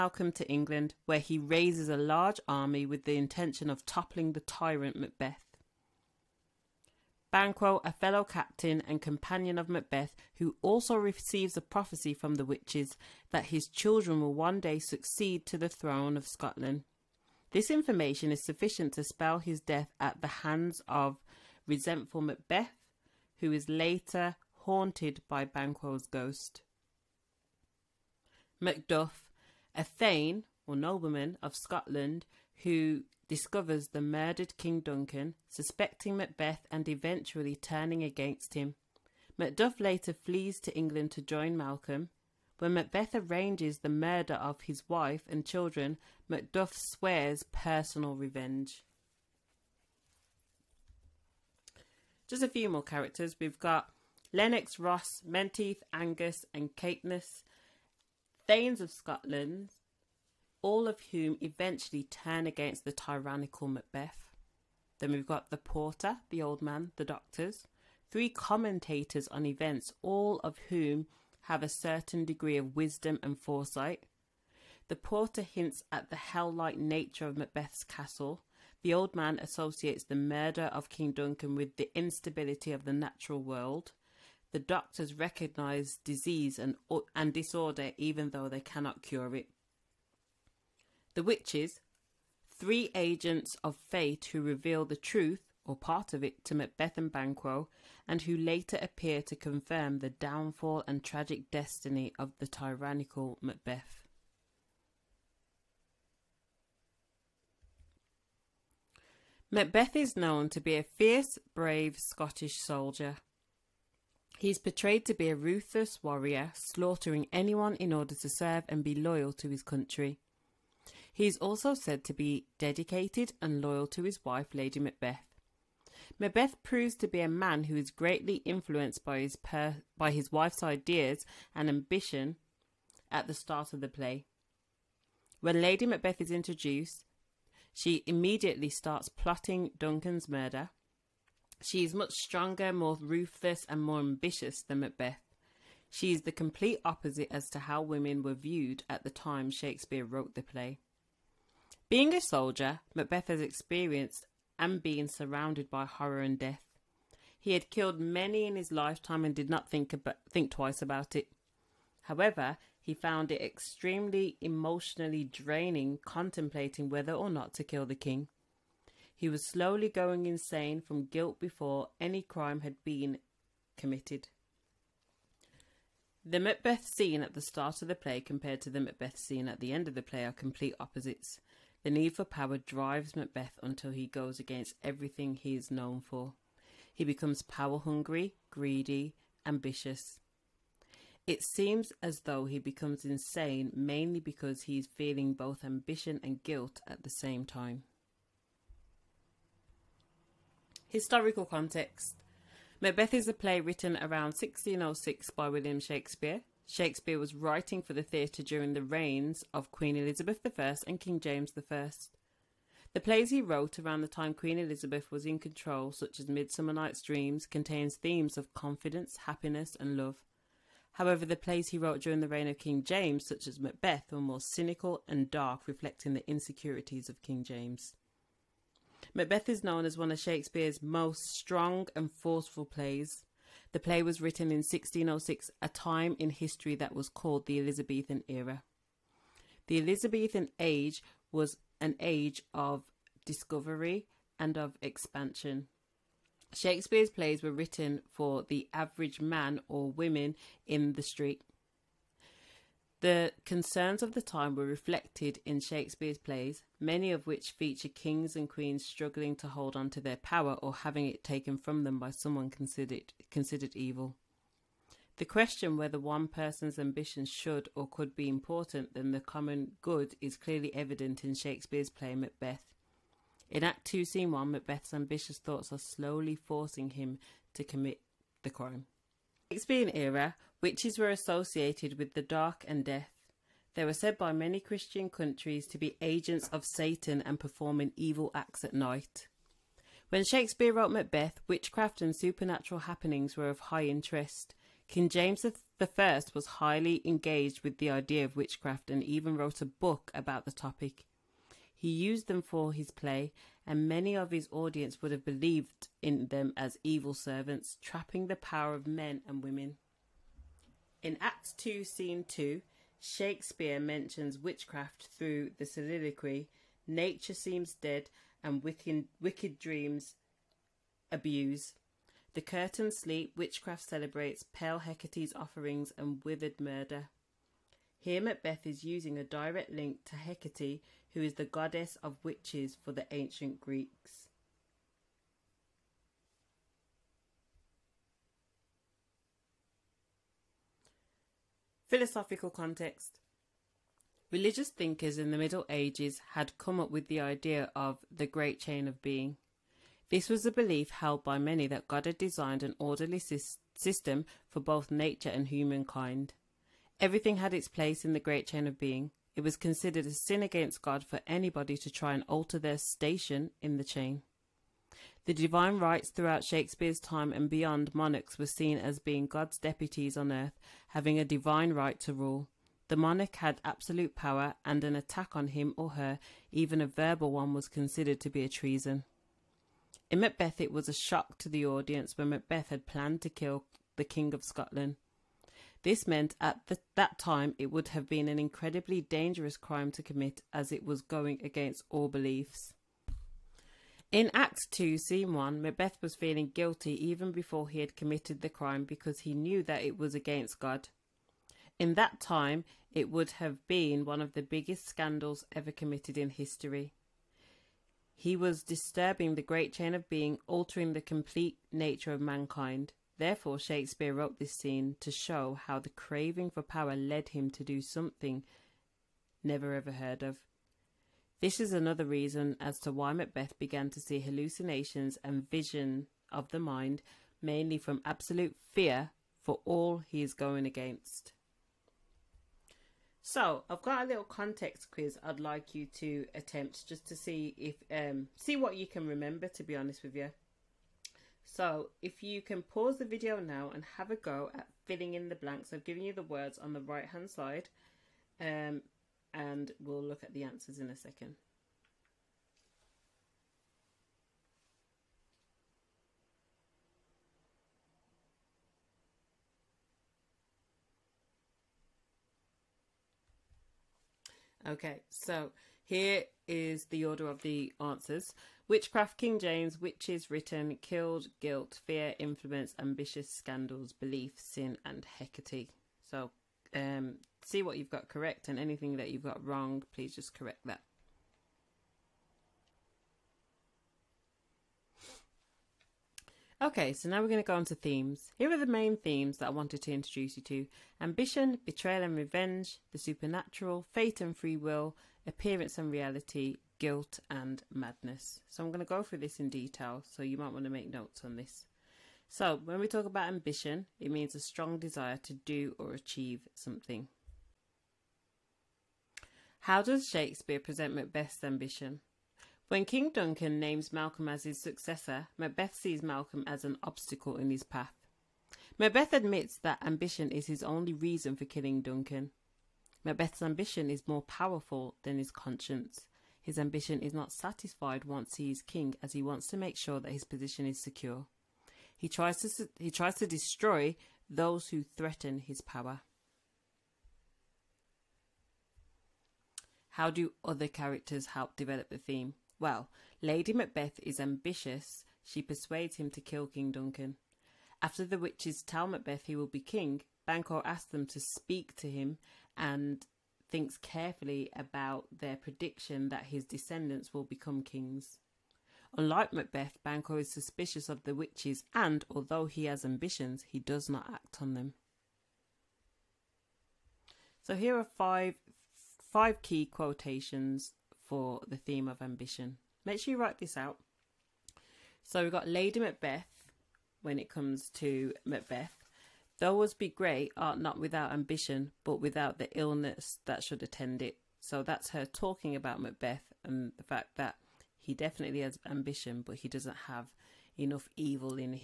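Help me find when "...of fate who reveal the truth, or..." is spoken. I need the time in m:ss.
1:33.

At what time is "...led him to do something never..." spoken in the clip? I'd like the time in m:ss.
6:56.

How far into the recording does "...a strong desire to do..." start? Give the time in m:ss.
8:24.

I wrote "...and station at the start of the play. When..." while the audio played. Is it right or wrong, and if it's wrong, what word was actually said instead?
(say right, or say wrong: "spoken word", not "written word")
wrong: "ambition", not "station".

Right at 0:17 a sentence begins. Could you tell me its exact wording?
This information is sufficient to spell his death at the hands of resentful Macbeth, who is later haunted by Banquo's ghost.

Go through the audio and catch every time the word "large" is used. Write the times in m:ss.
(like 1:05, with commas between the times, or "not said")
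0:01.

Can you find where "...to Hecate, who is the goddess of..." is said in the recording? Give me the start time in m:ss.
5:30.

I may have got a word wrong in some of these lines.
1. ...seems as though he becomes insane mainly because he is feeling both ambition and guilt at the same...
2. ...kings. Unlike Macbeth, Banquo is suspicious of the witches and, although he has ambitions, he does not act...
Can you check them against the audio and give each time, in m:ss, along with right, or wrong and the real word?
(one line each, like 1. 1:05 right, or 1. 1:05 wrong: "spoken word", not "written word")
1. 3:11 right
2. 9:17 right.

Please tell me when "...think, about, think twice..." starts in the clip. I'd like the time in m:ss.
2:39.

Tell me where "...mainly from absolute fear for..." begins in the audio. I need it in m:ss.
7:07.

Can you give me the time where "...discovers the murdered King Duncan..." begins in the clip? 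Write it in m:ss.
0:33.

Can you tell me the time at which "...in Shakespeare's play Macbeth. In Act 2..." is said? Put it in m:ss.
4:31.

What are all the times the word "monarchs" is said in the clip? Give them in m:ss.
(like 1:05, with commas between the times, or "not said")
6:07, 6:12.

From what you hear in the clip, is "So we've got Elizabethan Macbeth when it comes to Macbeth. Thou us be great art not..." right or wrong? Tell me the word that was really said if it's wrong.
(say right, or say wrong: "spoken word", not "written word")
wrong: "Lady", not "Elizabethan".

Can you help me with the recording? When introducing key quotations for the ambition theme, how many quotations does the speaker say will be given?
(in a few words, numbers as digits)
5.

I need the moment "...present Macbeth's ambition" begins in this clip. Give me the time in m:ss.
8:30.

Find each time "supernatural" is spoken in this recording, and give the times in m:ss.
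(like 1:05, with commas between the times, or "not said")
4:52, 8:12.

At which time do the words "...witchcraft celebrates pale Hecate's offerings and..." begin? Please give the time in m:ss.
5:23.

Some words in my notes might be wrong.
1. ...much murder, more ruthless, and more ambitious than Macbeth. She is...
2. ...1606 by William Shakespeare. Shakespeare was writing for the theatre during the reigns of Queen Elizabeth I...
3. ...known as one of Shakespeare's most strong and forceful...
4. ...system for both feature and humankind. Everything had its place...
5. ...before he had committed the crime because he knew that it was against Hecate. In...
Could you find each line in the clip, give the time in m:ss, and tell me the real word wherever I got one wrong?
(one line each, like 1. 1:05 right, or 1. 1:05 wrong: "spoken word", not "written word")
1. 2:21 wrong: "stronger", not "murder"
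2. 3:24 right
3. 3:49 right
4. 5:53 wrong: "nature", not "feature"
5. 6:37 wrong: "God", not "Hecate".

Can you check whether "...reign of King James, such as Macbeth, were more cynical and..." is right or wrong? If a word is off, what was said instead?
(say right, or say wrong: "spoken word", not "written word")
right.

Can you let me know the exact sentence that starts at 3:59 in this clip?
The Elizabethan age was an age of discovery and of expansion.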